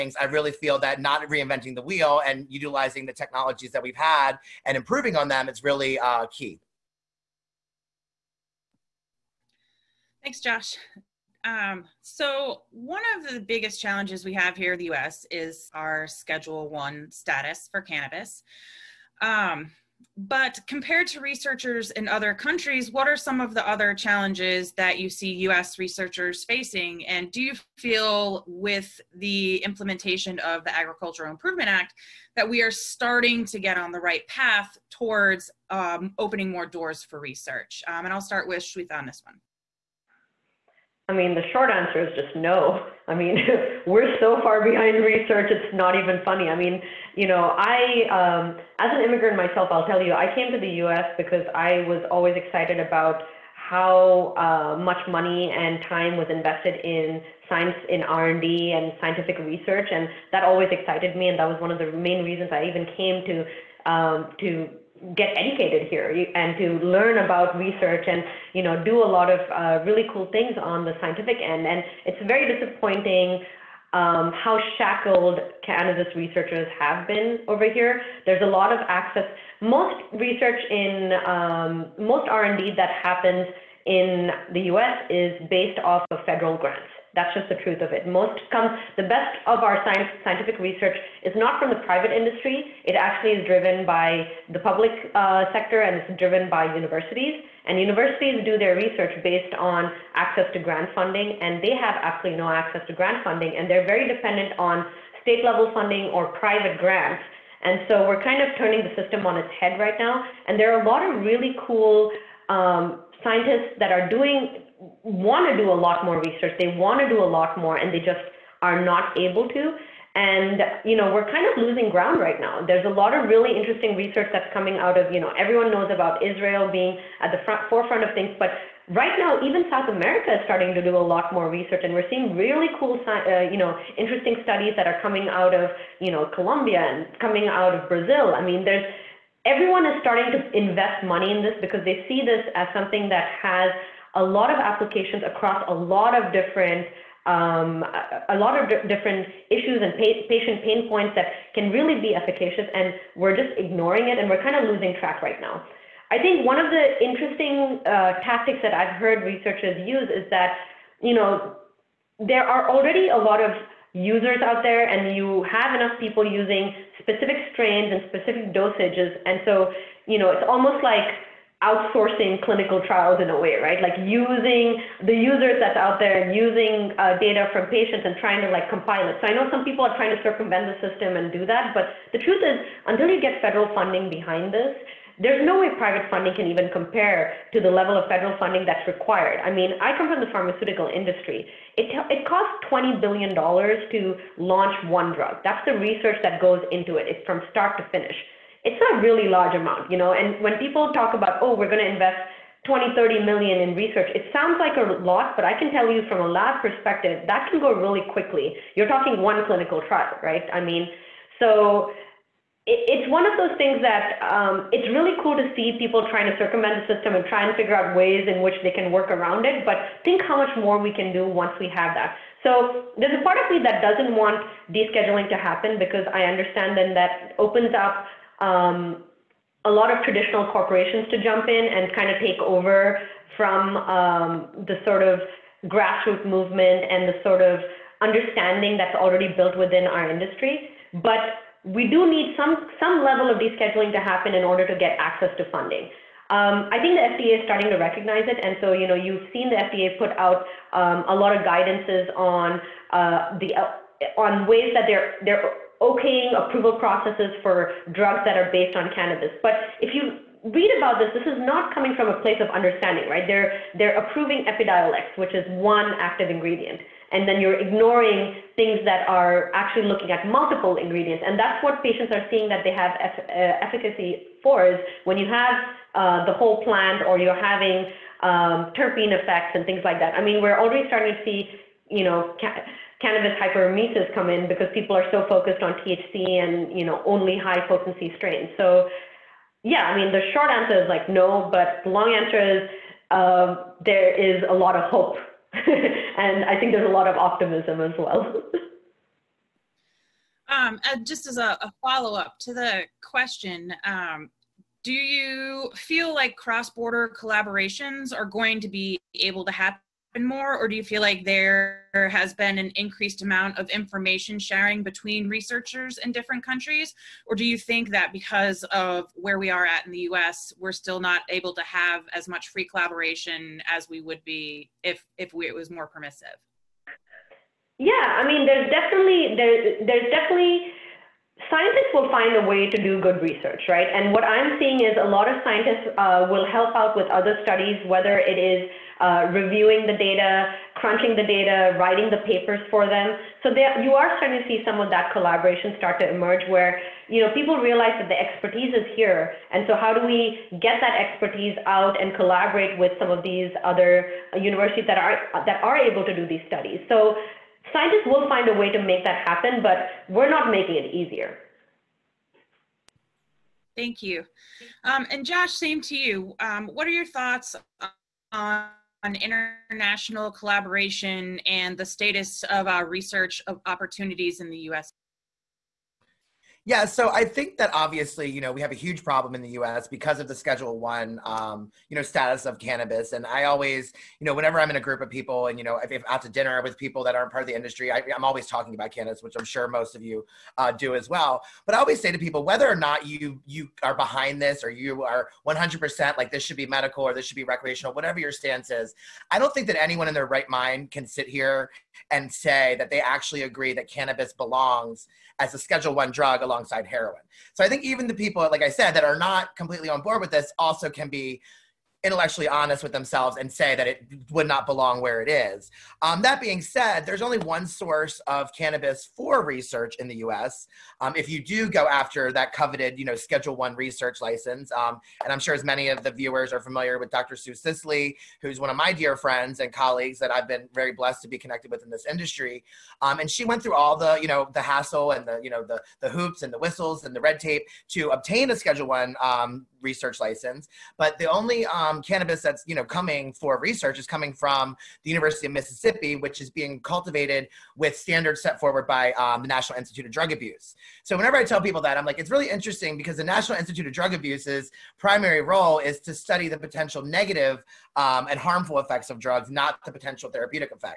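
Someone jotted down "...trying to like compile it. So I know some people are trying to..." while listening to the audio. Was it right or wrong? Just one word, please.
right.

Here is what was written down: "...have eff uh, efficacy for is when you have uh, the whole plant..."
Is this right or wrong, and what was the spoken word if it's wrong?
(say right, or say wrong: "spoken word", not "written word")
right.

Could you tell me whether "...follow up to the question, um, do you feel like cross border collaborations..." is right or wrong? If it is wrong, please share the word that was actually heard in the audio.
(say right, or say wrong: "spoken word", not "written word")
right.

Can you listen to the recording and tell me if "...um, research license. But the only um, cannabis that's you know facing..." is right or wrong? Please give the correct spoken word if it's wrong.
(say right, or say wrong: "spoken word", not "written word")
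wrong: "coming", not "facing".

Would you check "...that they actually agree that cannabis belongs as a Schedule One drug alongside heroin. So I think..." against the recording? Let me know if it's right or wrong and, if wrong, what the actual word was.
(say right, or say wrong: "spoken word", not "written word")
right.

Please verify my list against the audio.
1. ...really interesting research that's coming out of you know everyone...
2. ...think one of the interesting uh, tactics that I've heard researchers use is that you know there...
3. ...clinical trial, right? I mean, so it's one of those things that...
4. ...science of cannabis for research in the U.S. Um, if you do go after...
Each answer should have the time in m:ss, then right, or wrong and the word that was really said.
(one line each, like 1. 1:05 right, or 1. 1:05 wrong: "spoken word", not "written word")
1. 2:03 right
2. 2:36 right
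3. 3:29 right
4. 6:57 wrong: "source", not "science".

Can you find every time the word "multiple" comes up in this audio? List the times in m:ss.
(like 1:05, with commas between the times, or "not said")
4:30.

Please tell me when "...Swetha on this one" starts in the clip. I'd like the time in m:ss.
0:38.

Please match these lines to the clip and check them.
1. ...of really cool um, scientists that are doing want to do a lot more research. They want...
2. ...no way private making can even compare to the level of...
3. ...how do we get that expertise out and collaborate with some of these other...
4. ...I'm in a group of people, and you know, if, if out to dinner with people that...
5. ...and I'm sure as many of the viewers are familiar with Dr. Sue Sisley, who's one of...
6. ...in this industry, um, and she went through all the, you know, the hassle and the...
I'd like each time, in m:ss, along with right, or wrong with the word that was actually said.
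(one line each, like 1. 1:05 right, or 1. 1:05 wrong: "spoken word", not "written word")
1. 1:51 right
2. 3:05 wrong: "funding", not "making"
3. 5:49 right
4. 6:24 right
5. 7:05 right
6. 7:11 right.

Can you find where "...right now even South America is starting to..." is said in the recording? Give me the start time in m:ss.
2:08.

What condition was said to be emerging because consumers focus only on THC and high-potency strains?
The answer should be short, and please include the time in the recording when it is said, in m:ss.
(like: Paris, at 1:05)
cannabis hyperemesis, at 4:43.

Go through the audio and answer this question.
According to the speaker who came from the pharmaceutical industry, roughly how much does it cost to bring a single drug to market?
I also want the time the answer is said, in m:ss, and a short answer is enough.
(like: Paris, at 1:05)
$20 billion, at 3:12.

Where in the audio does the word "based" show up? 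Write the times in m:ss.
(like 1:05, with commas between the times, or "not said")
1:25, 1:39, 4:18.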